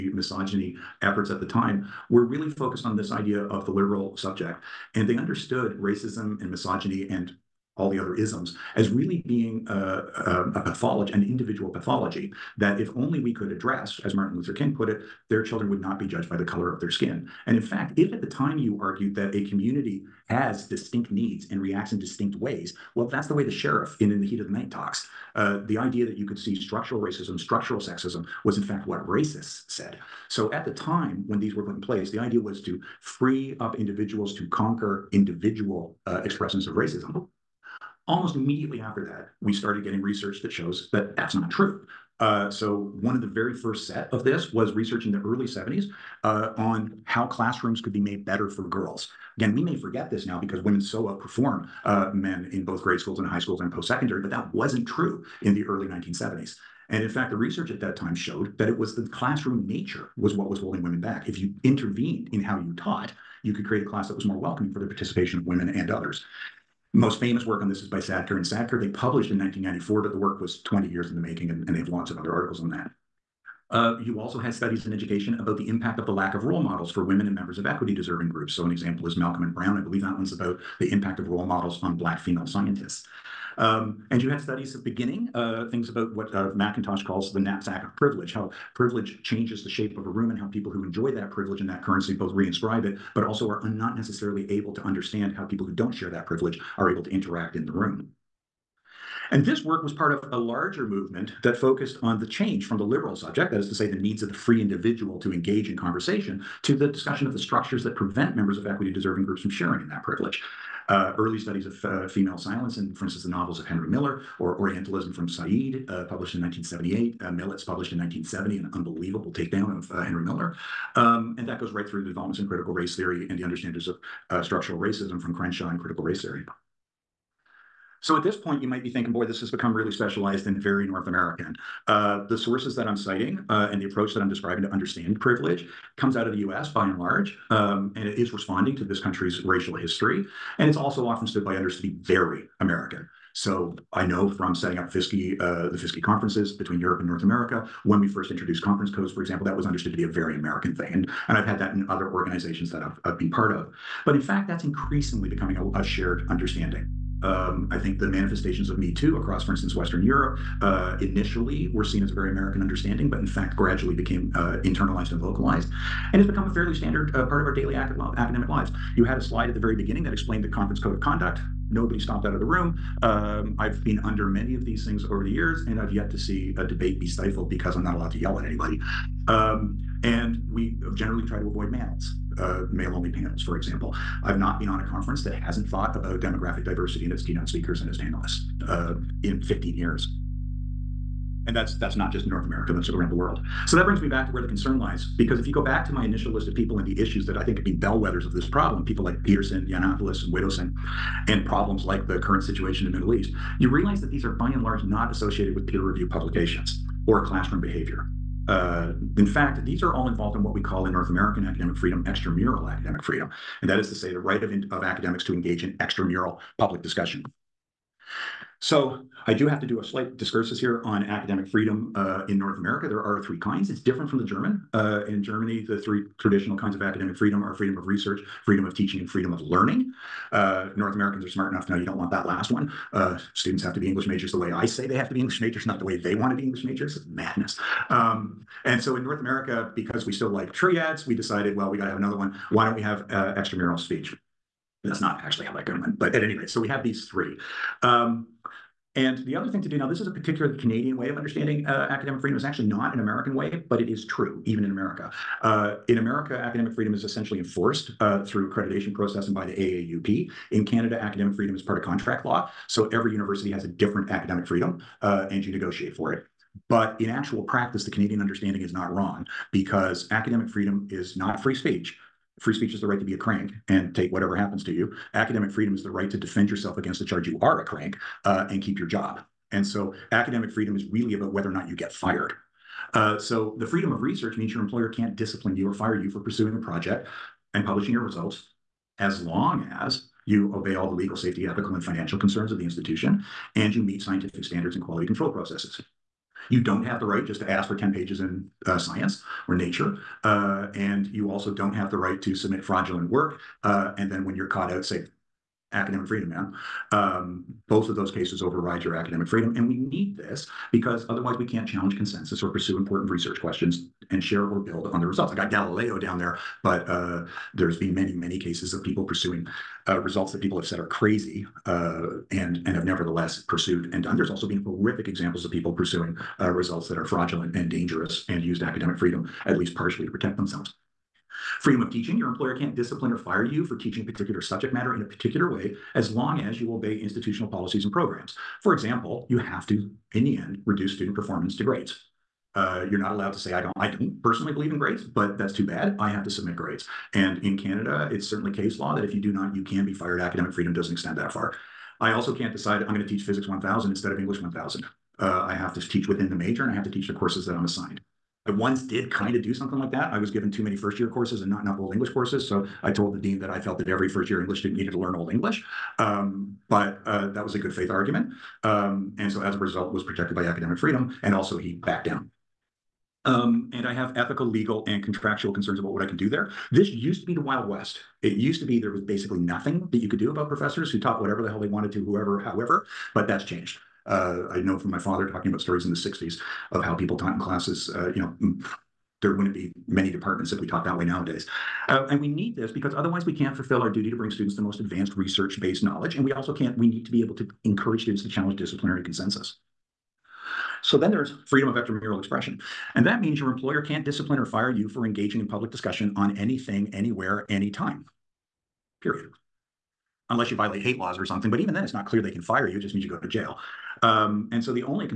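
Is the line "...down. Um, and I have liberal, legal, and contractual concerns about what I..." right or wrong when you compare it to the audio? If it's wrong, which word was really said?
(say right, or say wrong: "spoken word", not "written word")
wrong: "ethical", not "liberal".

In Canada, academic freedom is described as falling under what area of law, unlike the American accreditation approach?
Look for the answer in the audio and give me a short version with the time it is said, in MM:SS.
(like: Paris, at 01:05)
contract law, at 04:21.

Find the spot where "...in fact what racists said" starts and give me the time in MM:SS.
00:28.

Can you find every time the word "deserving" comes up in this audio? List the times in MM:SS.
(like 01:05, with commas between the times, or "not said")
01:17, 01:48.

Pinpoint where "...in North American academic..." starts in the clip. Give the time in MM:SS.
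03:30.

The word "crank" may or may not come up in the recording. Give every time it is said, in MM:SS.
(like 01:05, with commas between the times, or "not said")
04:33, 04:37.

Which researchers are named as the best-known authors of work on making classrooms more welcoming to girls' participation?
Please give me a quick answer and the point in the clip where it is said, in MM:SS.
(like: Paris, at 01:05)
Sadker and Sadker, at 01:07.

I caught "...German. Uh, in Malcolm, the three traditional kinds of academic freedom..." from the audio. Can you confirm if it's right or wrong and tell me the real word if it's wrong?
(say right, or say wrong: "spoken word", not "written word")
wrong: "Germany", not "Malcolm".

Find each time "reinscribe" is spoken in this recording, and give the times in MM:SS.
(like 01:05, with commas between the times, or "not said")
01:32.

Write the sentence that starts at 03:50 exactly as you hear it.
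Uh, North Americans are smart enough to know you don't want that last one.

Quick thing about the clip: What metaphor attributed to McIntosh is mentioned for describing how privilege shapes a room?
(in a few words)
knapsack of privilege.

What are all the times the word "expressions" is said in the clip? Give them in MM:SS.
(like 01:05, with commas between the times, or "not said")
00:36, 06:42.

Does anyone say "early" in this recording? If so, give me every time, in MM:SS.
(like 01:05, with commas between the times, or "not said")
00:45, 00:55, 01:51.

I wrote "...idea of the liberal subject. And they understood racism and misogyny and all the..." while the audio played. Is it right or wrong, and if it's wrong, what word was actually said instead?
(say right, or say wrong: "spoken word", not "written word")
right.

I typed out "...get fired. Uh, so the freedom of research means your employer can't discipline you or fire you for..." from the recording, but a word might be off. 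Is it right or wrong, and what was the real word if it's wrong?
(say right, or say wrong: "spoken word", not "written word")
right.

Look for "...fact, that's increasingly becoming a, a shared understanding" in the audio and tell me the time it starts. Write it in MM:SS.
02:34.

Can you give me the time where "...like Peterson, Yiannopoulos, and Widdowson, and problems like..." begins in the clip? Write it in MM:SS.
03:19.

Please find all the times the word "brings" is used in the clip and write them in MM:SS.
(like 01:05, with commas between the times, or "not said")
03:13, 06:34.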